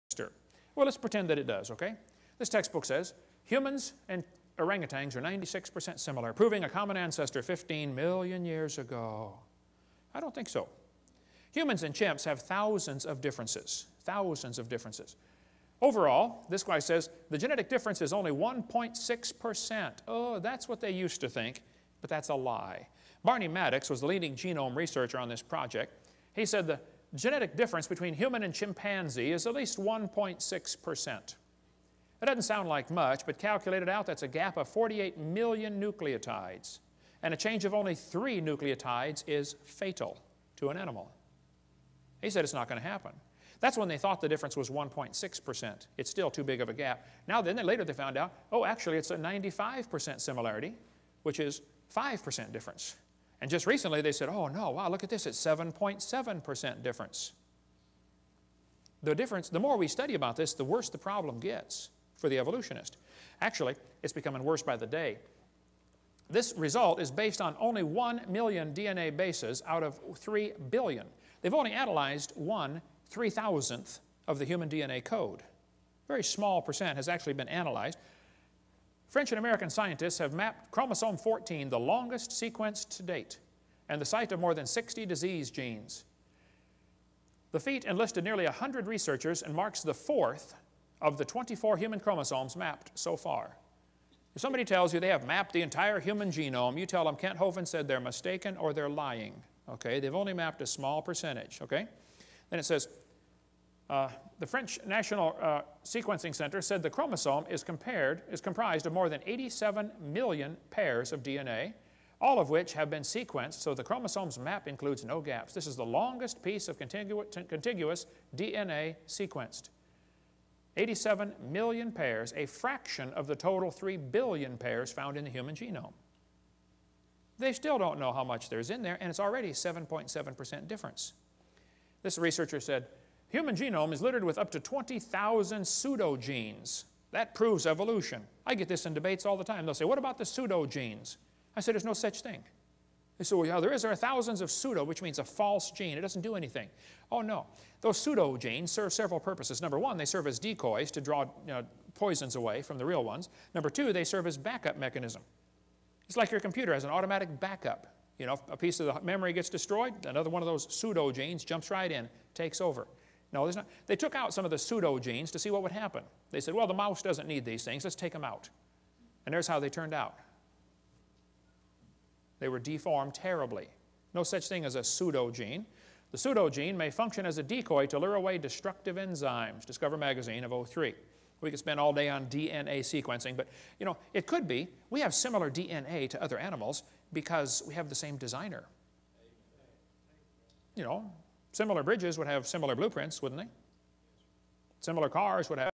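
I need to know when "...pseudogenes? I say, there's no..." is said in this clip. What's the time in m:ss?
2:20.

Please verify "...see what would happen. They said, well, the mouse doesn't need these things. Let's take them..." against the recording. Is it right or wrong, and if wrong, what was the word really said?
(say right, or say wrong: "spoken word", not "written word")
right.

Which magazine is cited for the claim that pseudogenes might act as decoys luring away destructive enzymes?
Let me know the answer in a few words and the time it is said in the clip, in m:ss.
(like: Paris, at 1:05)
Discover Magazine, at 2:59.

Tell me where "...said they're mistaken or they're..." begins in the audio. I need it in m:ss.
1:37.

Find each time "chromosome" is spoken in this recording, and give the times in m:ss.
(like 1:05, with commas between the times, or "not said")
1:20, 1:31, 1:46, 1:53.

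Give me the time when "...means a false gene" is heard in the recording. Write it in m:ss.
2:25.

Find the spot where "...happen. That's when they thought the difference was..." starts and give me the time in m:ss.
0:42.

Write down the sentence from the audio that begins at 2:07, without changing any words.
They still don't know how much there's in there, and it's already 7.7% difference.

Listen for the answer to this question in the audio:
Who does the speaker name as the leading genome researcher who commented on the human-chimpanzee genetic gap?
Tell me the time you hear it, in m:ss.
0:23.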